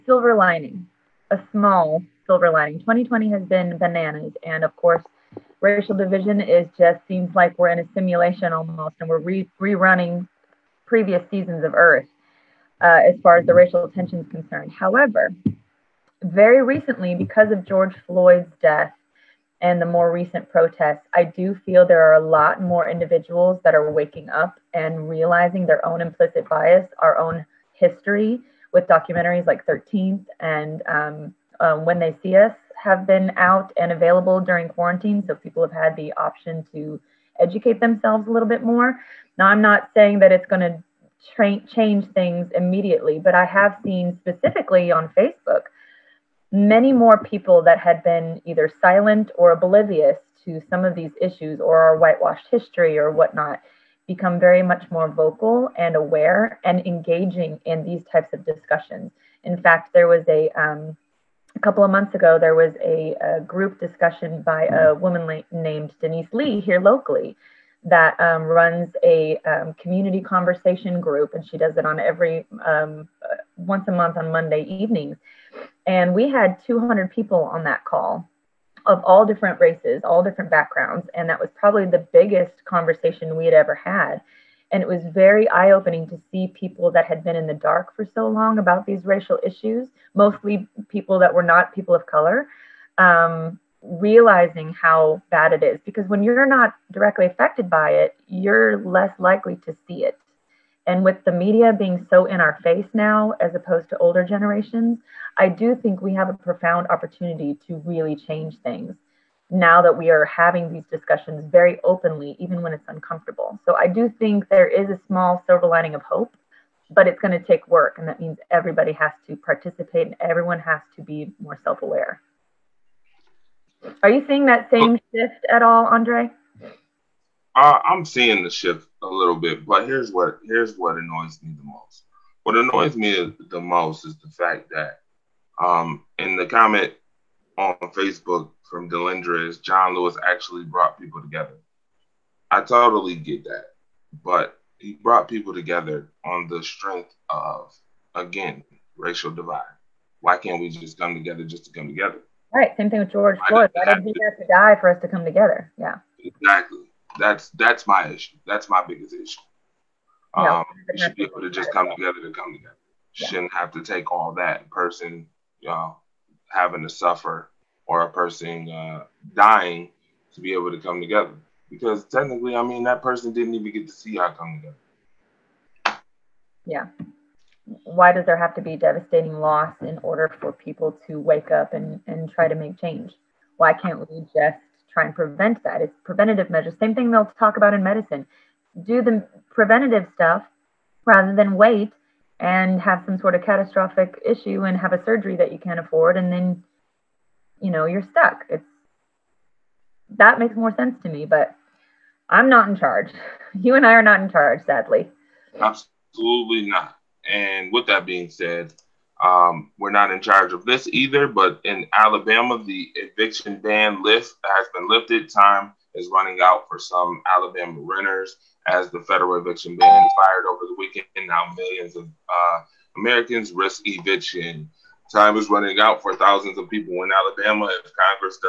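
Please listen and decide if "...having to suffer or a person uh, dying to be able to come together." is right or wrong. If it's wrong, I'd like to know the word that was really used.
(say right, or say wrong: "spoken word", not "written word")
right.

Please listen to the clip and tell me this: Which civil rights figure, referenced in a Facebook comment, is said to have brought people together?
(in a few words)
John Lewis.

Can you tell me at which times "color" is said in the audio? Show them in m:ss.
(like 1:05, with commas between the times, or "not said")
1:32.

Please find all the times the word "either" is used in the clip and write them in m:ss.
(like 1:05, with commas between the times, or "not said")
0:48, 3:30.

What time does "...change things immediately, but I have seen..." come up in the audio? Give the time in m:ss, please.
0:41.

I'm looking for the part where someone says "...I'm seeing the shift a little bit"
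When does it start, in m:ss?
2:07.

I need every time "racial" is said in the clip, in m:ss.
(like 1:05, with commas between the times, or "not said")
0:05, 0:13, 1:29, 2:28.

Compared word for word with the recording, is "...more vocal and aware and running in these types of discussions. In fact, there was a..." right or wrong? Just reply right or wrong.
wrong.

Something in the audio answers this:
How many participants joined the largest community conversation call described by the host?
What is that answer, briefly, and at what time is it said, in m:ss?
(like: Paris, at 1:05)
200, at 1:16.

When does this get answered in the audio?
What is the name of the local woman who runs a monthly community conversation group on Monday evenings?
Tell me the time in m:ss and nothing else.
1:06.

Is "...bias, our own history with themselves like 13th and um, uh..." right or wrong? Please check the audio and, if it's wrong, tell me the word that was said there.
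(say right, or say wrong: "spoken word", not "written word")
wrong: "documentaries", not "themselves".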